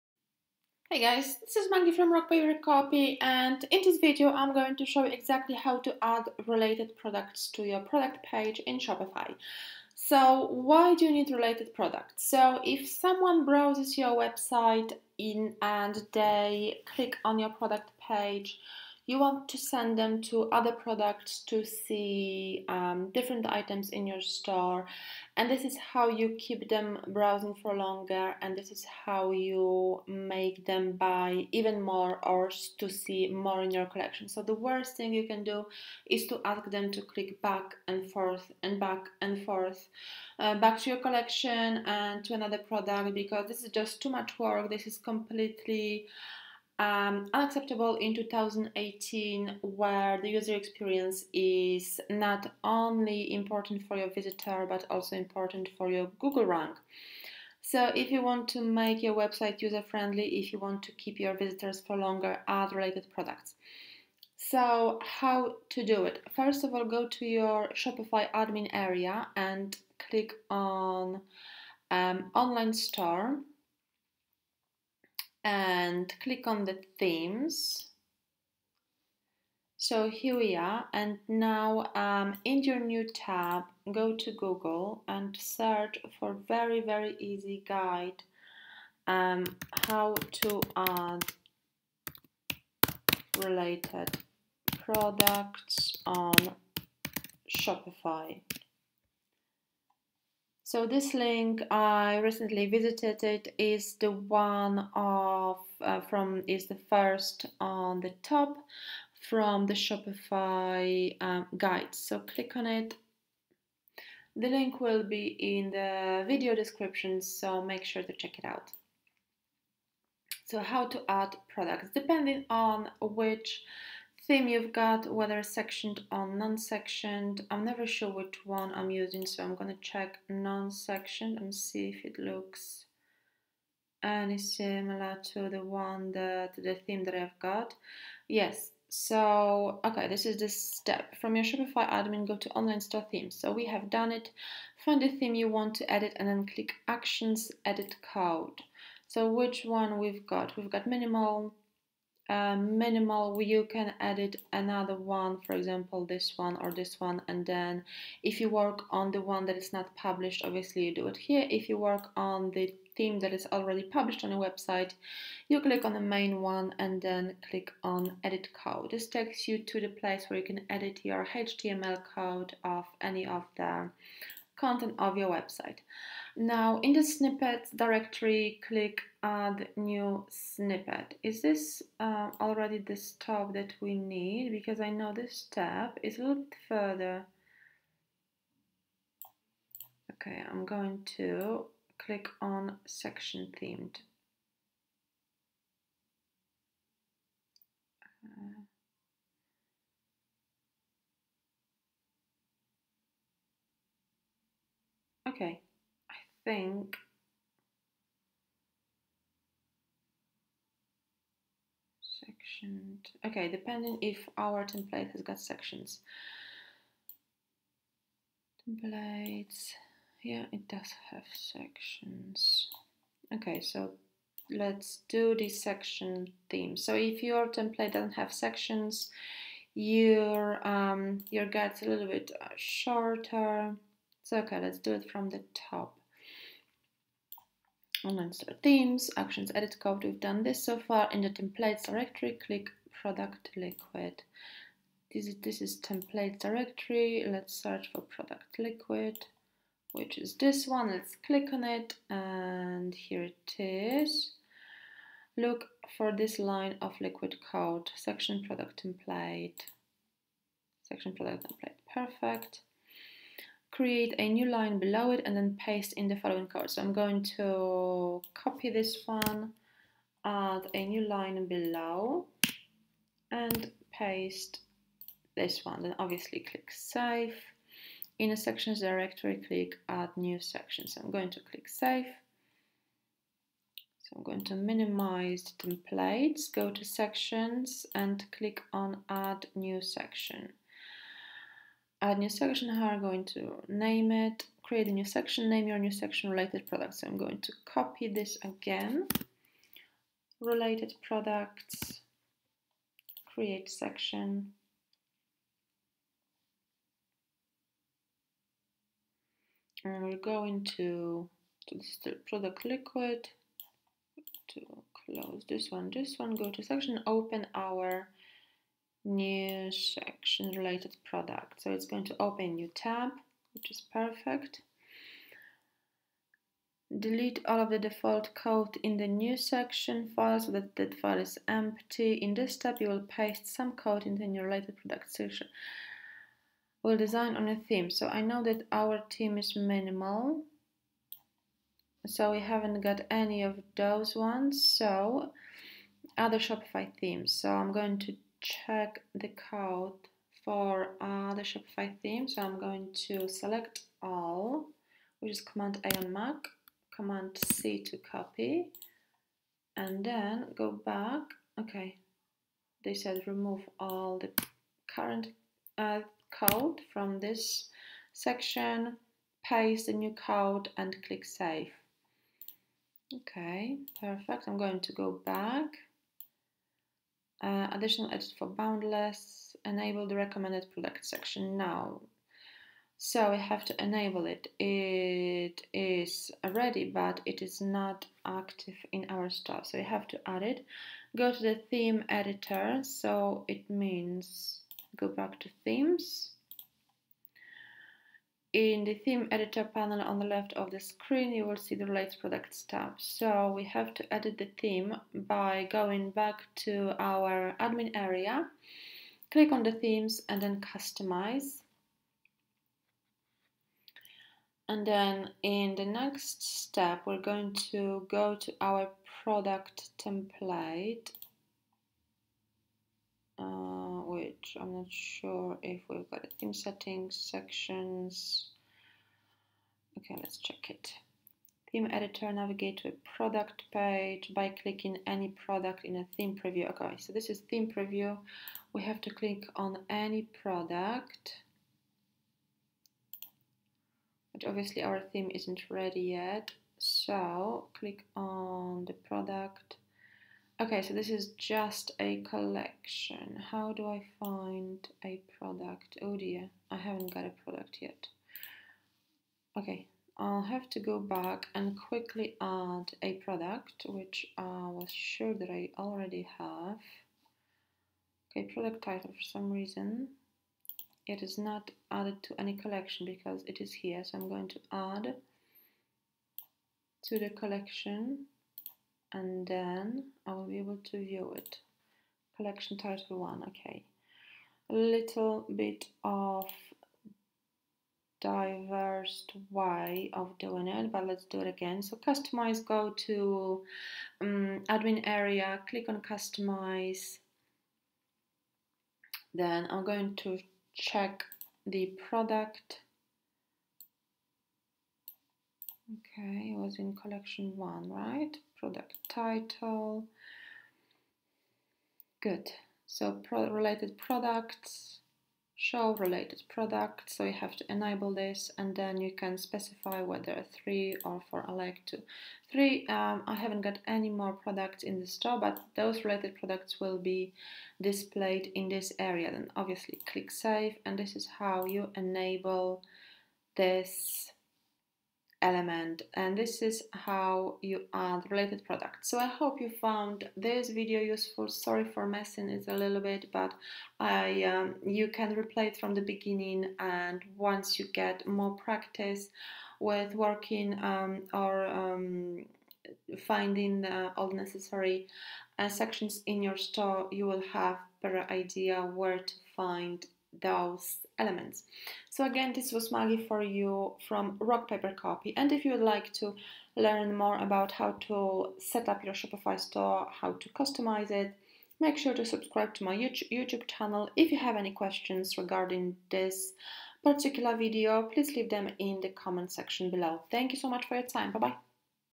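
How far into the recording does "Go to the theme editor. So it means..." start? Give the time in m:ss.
6:31.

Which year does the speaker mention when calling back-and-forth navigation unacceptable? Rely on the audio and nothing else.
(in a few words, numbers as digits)
2018.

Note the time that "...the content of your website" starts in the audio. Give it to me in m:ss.
2:53.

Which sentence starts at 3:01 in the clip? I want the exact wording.
Is this uh, already the stop that we need?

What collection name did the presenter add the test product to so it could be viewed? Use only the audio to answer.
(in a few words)
Collection title 1.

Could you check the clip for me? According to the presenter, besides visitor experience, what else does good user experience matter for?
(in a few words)
Google rank.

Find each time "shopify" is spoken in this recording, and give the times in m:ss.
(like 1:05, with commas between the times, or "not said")
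0:08, 1:07, 1:37, 1:49, 2:21, 5:46, 5:51, 9:29.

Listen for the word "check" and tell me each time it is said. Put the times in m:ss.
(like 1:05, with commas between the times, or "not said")
1:58, 2:09, 5:48, 7:10, 8:20.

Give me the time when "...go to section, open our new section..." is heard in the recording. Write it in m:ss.
5:16.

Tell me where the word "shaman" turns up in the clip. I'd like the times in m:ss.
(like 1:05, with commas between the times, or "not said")
not said.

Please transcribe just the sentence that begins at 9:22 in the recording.
So again, this was Maggie for you from Rock Paper Copy.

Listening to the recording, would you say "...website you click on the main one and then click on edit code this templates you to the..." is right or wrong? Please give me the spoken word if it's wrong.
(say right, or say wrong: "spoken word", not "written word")
wrong: "takes", not "templates".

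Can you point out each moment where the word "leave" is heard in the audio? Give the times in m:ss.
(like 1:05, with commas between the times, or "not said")
9:38.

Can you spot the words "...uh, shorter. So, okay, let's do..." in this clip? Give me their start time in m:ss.
3:52.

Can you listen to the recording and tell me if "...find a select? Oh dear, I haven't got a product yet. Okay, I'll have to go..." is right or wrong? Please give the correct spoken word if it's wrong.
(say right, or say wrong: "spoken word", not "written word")
wrong: "product", not "select".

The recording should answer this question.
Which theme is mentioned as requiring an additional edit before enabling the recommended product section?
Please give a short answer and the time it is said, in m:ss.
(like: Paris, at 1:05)
Boundless, at 6:18.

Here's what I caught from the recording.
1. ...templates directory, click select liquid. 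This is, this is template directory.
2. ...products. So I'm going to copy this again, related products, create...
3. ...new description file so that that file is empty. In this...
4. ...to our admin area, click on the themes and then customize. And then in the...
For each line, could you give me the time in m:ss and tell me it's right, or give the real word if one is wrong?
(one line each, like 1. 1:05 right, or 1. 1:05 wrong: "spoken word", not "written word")
1. 4:01 wrong: "product", not "select"
2. 4:56 right
3. 5:29 wrong: "section", not "description"
4. 6:46 right.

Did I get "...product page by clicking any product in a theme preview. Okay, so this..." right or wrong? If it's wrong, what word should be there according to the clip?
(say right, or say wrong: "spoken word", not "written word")
right.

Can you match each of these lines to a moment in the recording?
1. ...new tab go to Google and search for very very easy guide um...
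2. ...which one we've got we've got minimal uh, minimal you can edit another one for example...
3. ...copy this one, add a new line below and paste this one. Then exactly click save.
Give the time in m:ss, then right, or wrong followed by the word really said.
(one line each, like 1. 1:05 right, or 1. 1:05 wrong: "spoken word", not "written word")
1. 1:22 right
2. 2:29 right
3. 4:28 wrong: "obviously", not "exactly".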